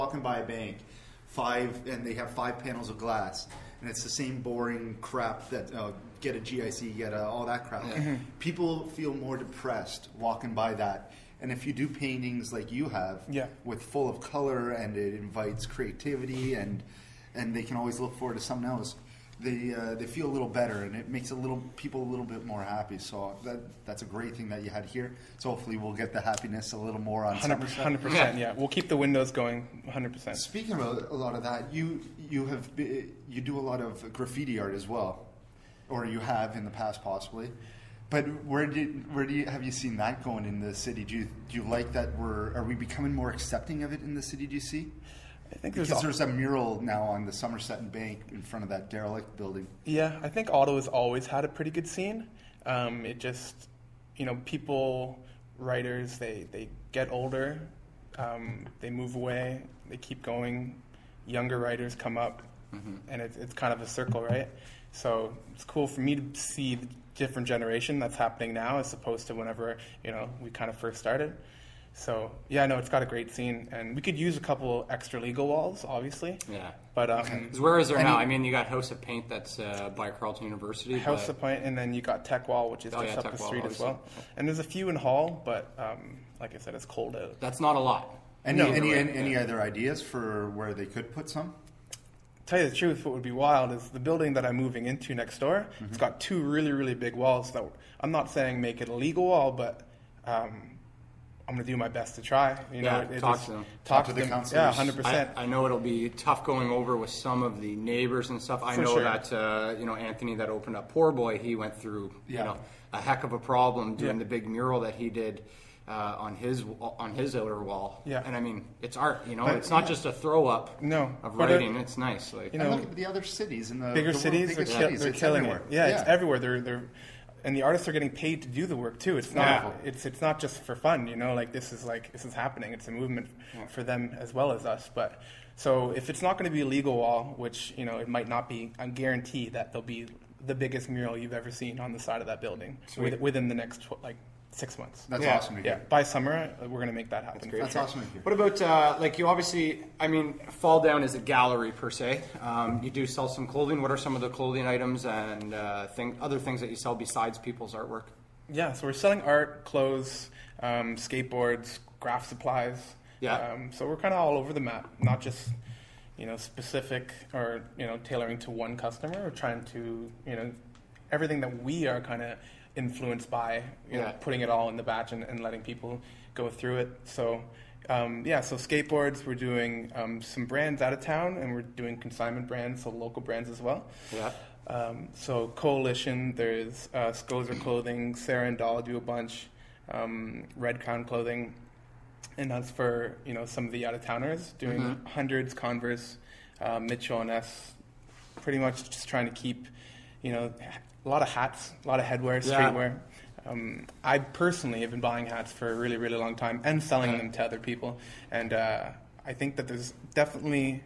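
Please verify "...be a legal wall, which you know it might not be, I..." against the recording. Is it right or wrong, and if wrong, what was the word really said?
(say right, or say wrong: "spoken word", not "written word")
right.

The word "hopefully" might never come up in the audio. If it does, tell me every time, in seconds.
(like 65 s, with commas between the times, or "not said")
25 s.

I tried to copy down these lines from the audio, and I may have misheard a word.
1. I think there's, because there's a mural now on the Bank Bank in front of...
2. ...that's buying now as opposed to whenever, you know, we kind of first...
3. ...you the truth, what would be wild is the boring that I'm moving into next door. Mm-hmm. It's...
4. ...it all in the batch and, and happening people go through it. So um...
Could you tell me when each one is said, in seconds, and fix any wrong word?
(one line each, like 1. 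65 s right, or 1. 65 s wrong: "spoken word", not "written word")
1. 45 s wrong: "Somerset", not "Bank"
2. 68 s wrong: "happening", not "buying"
3. 92 s wrong: "building", not "boring"
4. 174 s wrong: "letting", not "happening".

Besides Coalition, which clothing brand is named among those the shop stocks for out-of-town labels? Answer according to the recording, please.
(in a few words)
Red Crown Clothing.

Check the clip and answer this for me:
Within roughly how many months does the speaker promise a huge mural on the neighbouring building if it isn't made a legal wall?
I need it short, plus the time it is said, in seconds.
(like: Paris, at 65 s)
6 months, at 144 s.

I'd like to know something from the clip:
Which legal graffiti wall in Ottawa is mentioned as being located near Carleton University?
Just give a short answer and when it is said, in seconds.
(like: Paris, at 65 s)
House of Paint, at 78 s.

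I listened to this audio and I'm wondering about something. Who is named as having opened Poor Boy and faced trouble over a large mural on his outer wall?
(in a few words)
Anthony.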